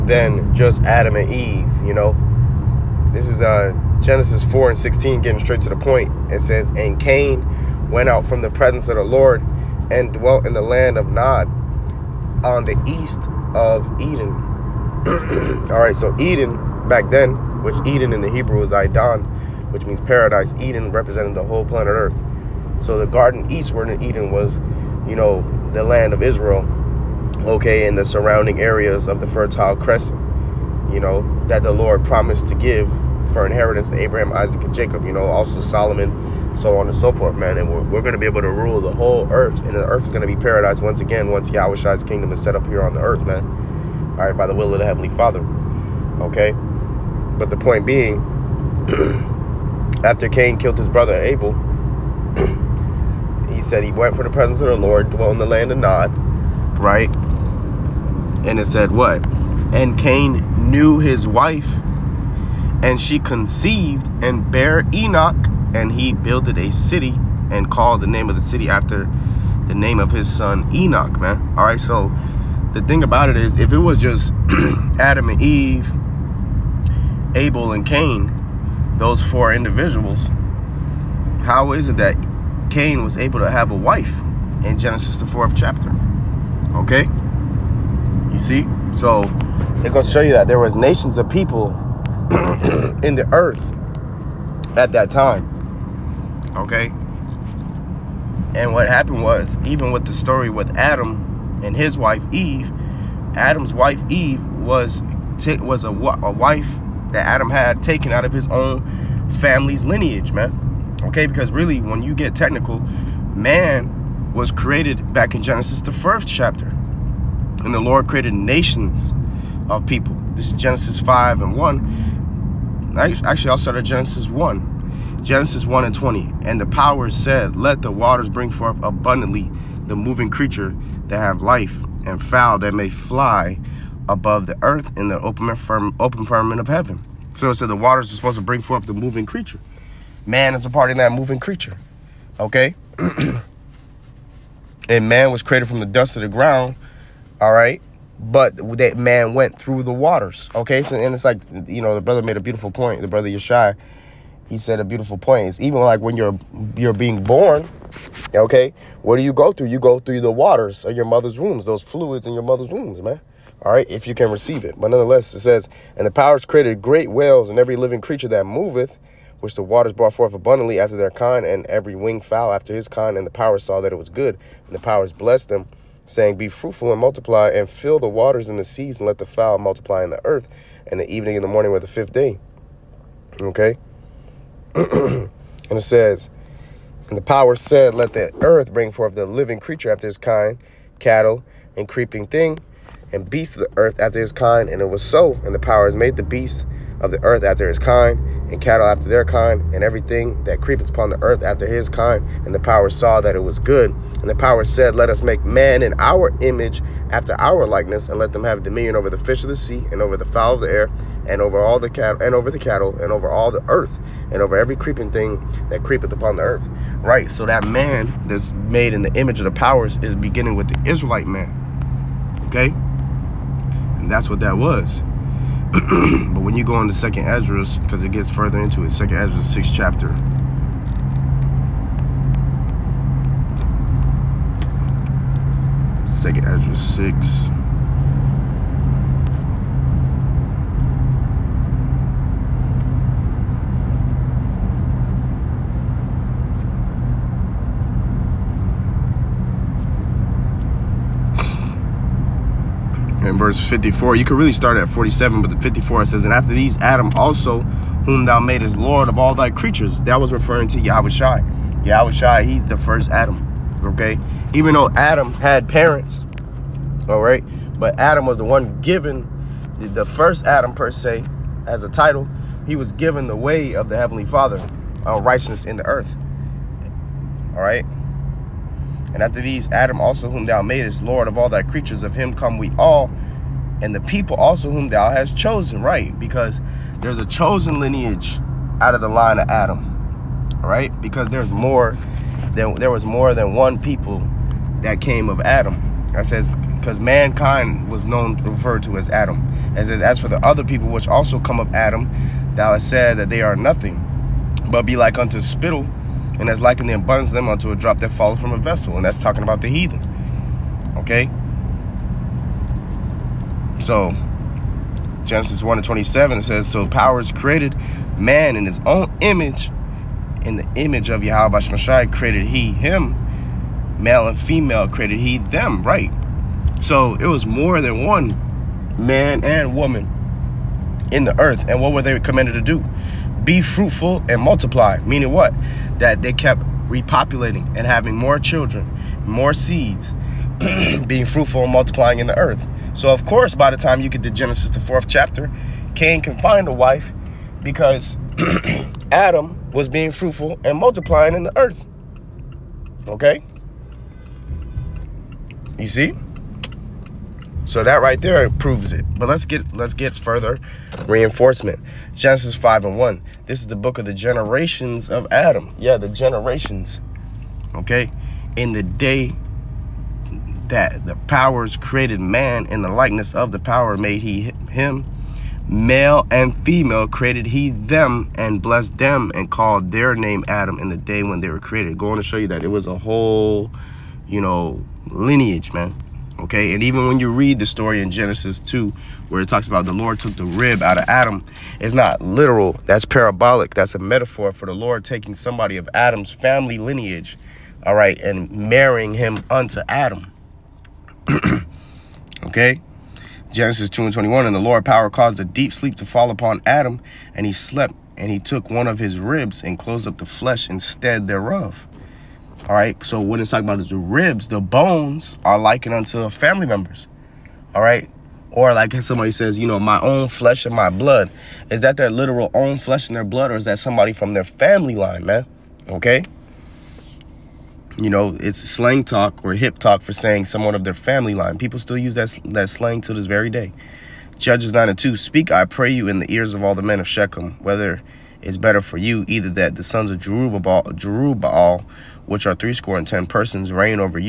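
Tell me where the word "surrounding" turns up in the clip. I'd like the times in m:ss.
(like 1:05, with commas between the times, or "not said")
0:28.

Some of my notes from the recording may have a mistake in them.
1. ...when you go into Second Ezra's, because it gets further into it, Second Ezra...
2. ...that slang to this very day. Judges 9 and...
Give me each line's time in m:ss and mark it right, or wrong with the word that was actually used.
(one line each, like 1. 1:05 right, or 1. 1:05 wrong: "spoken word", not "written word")
1. 3:46 right
2. 7:12 right.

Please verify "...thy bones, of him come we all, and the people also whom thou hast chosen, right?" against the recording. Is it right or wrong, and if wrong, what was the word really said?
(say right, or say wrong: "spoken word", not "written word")
wrong: "creatures", not "bones".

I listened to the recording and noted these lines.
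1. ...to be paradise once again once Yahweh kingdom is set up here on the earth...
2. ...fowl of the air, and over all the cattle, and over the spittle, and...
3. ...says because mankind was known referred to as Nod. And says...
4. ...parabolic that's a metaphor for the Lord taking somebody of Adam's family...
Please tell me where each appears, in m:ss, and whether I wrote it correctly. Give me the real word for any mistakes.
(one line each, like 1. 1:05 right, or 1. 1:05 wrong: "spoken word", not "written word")
1. 0:40 right
2. 3:30 wrong: "cattle", not "spittle"
3. 4:56 wrong: "Adam", not "Nod"
4. 6:33 right.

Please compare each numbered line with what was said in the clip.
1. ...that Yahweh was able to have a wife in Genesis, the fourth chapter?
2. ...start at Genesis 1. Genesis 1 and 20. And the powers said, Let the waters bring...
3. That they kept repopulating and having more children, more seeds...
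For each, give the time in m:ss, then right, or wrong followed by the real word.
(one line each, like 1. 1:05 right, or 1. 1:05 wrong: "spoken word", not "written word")
1. 1:21 wrong: "Cain", not "Yahweh"
2. 2:03 right
3. 5:35 right.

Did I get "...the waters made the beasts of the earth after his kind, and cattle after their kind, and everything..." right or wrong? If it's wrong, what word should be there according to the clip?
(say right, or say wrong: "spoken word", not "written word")
wrong: "powers", not "waters".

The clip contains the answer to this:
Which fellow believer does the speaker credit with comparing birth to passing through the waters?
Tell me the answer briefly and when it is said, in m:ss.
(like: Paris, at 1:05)
Yeshai, at 2:33.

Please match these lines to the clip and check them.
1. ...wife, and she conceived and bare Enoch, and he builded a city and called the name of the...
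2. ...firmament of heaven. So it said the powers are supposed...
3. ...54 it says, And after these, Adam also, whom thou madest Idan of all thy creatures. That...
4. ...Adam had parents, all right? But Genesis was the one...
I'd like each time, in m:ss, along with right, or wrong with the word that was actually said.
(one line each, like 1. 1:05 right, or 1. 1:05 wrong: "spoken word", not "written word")
1. 1:01 right
2. 2:16 wrong: "waters", not "powers"
3. 4:15 wrong: "Lord", not "Idan"
4. 4:24 wrong: "Adam", not "Genesis".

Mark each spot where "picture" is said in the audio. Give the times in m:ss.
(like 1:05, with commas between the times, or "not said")
not said.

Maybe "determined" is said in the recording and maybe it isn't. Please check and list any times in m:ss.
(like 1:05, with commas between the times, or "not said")
not said.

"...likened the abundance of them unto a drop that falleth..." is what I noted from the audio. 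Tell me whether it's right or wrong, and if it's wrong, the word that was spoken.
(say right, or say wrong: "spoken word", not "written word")
right.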